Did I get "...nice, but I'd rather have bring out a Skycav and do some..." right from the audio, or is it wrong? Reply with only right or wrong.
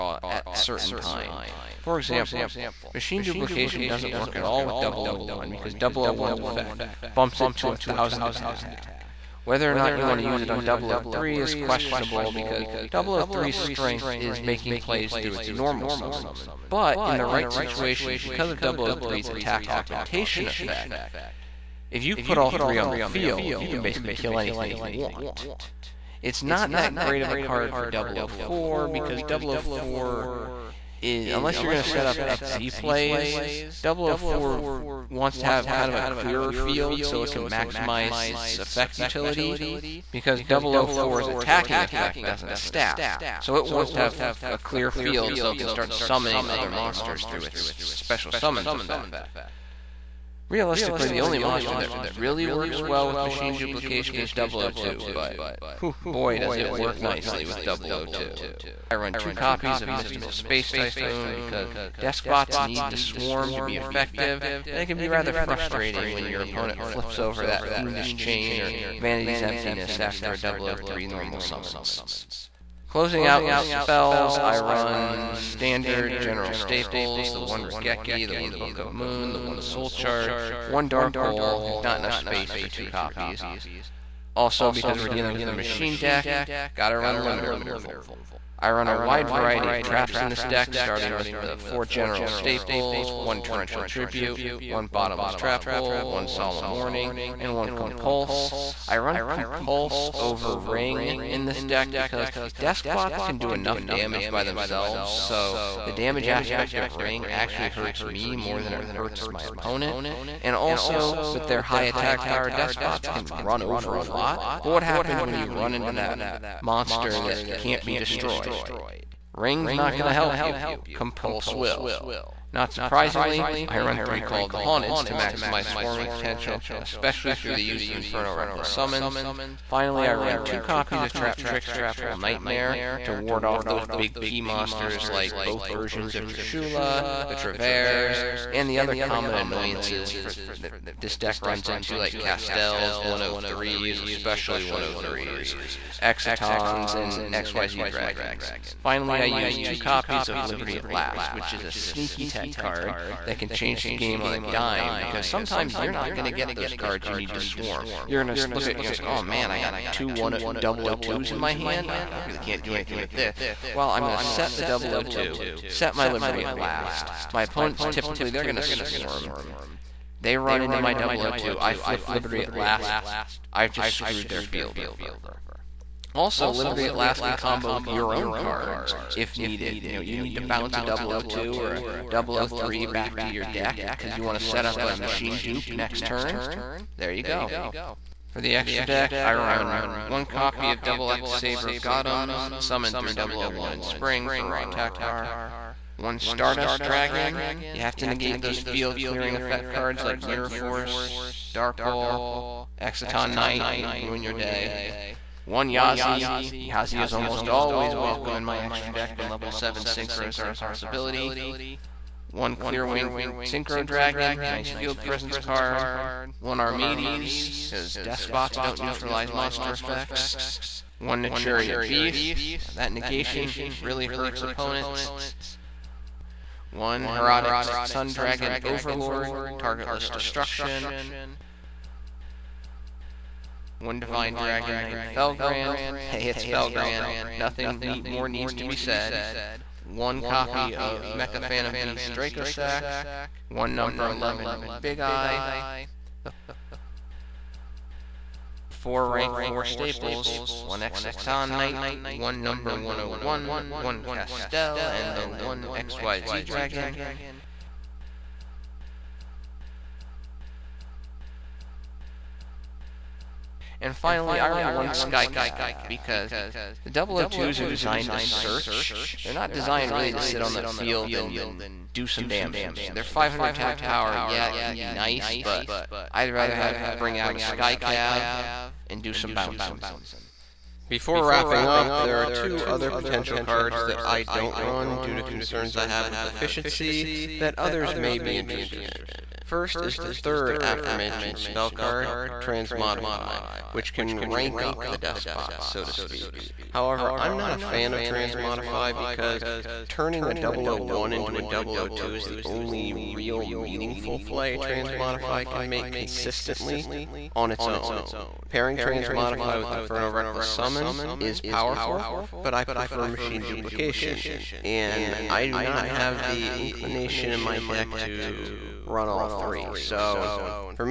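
right.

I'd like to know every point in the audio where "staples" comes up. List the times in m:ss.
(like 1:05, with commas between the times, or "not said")
1:16, 1:32, 4:09.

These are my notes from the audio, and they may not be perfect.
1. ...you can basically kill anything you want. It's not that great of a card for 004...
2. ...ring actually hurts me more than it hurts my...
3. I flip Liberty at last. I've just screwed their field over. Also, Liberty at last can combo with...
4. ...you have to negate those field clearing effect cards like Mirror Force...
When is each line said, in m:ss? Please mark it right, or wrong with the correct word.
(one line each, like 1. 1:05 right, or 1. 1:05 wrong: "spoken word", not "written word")
1. 0:23 right
2. 1:46 right
3. 2:51 right
4. 3:17 right.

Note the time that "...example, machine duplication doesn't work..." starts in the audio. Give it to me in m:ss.
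0:01.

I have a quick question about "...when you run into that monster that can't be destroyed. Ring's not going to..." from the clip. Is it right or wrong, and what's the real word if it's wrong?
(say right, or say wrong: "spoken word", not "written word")
right.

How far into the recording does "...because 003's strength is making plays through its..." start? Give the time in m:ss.
0:12.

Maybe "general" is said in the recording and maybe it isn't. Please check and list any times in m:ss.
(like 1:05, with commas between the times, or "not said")
1:16, 1:31.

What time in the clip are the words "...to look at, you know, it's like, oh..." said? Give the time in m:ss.
2:38.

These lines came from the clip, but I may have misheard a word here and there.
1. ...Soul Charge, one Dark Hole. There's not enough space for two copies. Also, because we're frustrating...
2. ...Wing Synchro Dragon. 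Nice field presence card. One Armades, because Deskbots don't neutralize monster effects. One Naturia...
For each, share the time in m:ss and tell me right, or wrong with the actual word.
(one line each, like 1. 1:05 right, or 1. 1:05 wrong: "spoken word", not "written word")
1. 1:19 wrong: "dealing", not "frustrating"
2. 3:32 right.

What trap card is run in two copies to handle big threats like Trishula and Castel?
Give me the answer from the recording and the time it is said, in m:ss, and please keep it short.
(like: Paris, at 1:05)
Traptrix Trap Hole Nightmare, at 2:11.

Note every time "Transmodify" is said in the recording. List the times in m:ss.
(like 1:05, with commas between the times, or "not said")
4:52, 4:58, 5:04, 5:08.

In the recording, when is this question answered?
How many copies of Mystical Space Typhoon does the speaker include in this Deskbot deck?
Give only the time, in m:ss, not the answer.
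0:59.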